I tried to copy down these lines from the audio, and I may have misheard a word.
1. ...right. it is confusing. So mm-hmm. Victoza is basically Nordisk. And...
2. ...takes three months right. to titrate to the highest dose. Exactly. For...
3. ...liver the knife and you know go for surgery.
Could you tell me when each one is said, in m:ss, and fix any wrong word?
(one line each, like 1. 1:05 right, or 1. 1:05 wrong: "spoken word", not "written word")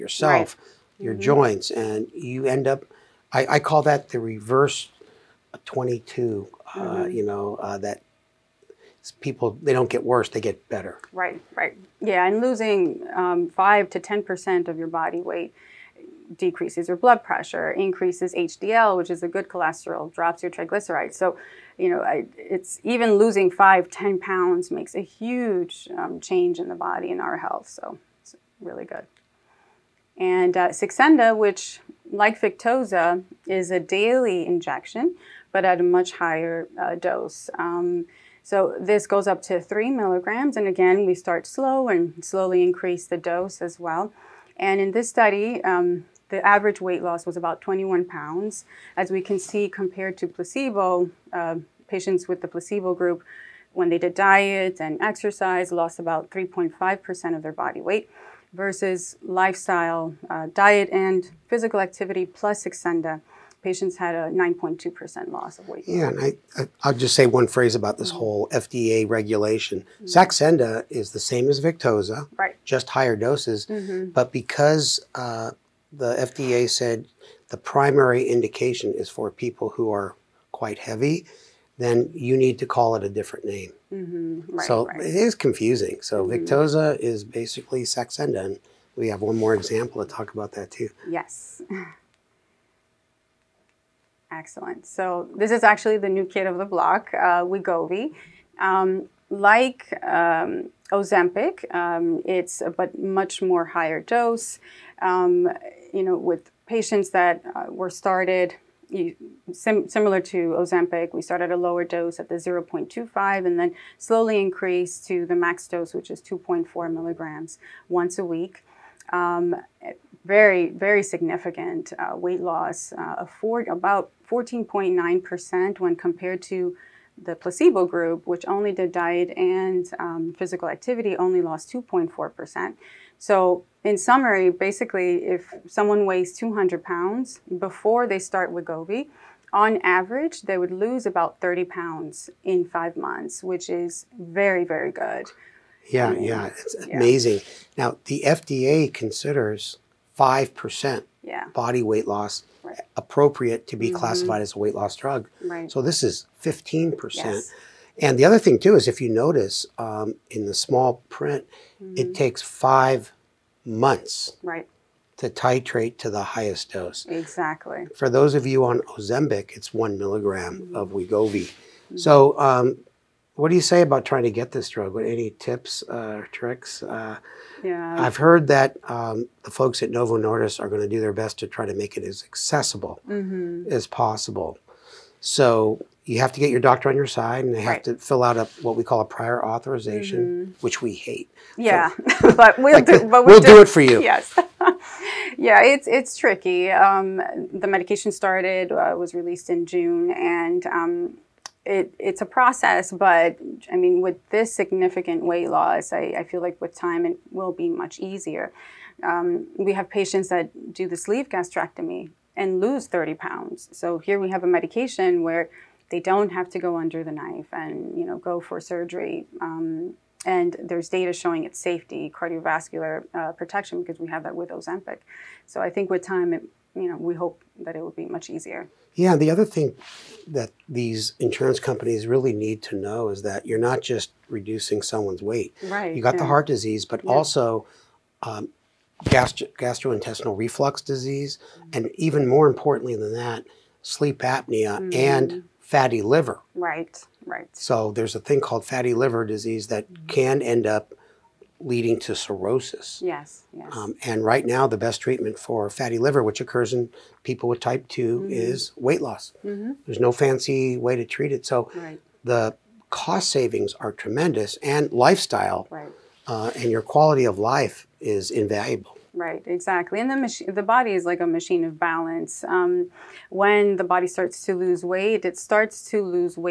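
1. 1:24 wrong: "Saxenda", not "Nordisk"
2. 2:42 wrong: "five", not "three"
3. 3:36 wrong: "under", not "liver".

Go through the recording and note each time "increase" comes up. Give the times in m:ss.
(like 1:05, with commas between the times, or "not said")
0:17, 0:42, 1:54.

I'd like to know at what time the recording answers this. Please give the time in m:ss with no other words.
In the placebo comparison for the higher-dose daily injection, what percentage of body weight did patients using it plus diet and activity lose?
1:04.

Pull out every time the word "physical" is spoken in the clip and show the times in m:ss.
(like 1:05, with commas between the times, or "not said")
1:01, 2:10.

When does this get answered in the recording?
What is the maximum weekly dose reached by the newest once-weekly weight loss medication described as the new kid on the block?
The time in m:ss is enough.
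1:56.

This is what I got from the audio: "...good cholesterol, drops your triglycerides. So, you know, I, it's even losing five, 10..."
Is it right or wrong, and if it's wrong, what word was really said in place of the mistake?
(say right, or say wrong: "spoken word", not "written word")
right.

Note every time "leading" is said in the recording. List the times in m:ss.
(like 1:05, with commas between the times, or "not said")
4:11.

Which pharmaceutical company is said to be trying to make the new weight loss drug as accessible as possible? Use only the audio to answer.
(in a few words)
Novo Nordisk.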